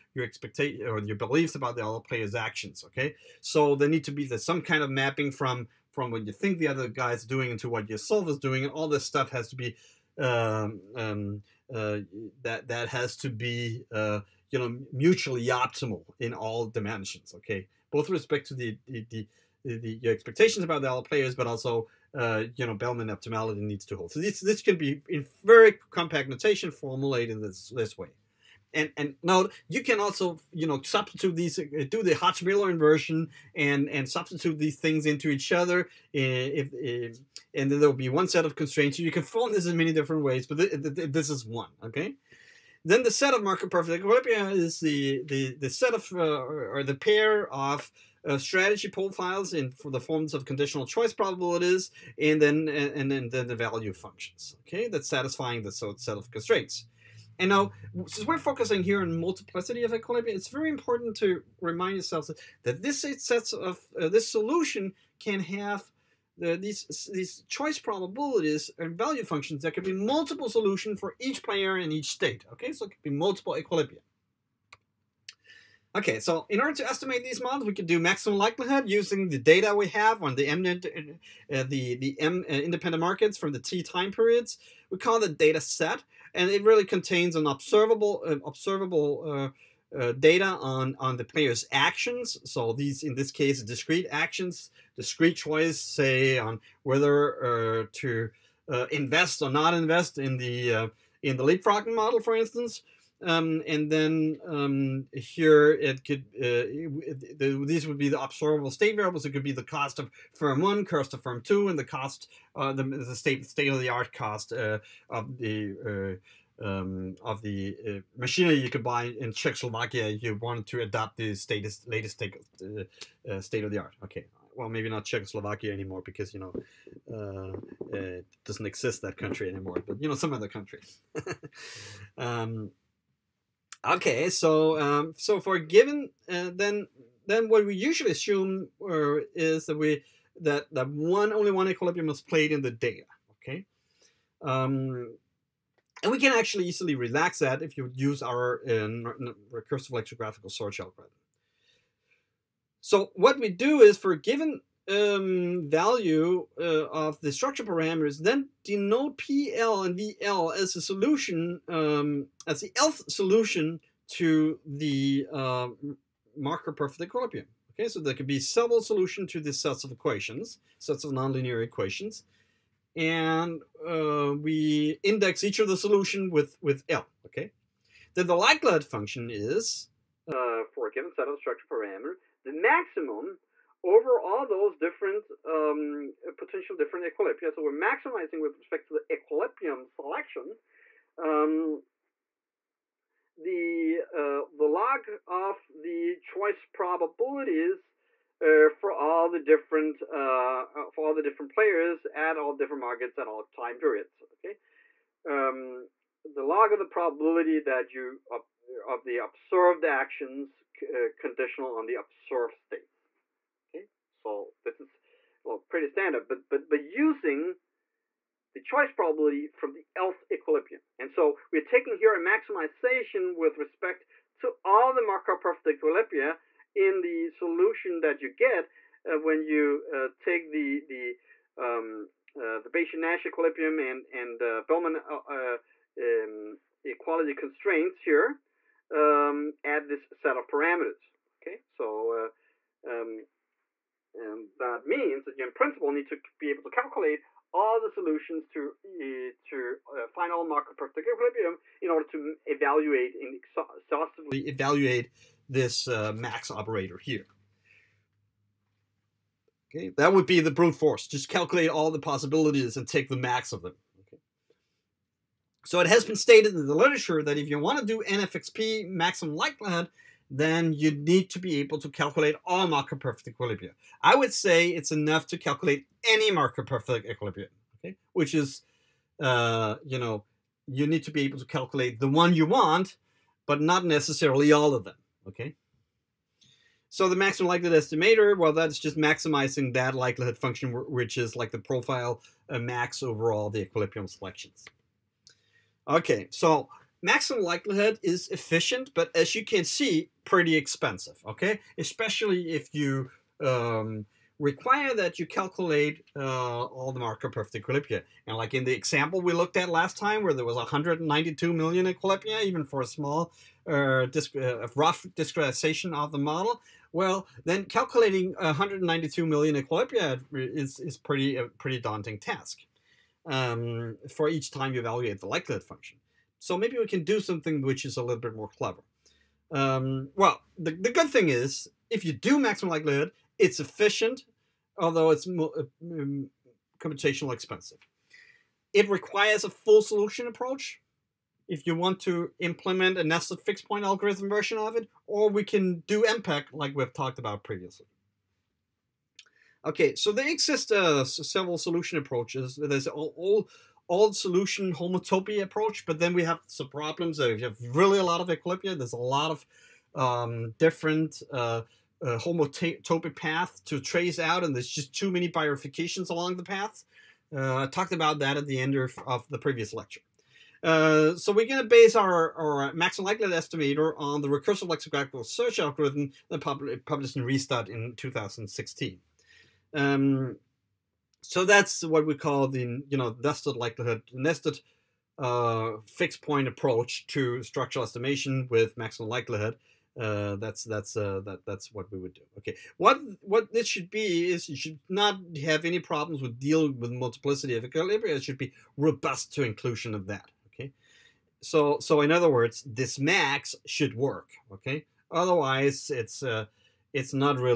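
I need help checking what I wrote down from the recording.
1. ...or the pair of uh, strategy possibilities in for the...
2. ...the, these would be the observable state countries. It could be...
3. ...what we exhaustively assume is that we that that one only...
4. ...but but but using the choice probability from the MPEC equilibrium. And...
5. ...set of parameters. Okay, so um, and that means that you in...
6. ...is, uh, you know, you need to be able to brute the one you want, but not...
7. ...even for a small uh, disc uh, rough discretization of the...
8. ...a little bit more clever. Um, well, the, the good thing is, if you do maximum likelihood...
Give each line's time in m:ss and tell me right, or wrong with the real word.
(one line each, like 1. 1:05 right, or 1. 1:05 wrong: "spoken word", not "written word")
1. 0:46 wrong: "profiles", not "possibilities"
2. 1:47 wrong: "variables", not "countries"
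3. 2:17 wrong: "usually", not "exhaustively"
4. 3:36 wrong: "Lth", not "MPEC"
5. 4:00 right
6. 4:38 wrong: "calculate", not "brute"
7. 5:12 right
8. 5:27 right.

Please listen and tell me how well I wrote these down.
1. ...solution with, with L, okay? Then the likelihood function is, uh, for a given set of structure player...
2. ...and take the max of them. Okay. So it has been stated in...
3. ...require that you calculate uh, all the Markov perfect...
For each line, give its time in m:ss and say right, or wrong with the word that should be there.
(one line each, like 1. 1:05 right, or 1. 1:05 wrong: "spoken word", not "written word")
1. 2:55 wrong: "parameter", not "player"
2. 4:22 right
3. 5:04 right.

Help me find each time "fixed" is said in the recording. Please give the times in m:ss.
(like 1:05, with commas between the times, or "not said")
5:43, 6:25.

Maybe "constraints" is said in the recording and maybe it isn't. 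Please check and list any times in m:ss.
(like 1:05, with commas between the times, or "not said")
0:38, 0:56, 3:57.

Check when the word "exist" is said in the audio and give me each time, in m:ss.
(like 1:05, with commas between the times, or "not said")
2:08, 5:50.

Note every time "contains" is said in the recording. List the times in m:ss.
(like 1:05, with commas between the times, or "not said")
1:26.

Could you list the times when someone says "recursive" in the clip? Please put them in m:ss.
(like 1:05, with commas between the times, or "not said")
2:29, 6:14.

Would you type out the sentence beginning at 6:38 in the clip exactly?
It should be robust to inclusion of that so so in other words, this max should work.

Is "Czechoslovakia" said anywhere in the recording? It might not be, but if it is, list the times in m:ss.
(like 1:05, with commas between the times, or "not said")
1:59, 2:05.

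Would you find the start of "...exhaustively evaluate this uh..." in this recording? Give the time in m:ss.
4:13.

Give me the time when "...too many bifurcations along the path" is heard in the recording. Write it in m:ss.
6:04.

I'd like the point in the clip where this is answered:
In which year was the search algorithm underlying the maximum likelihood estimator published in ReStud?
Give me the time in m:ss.
6:17.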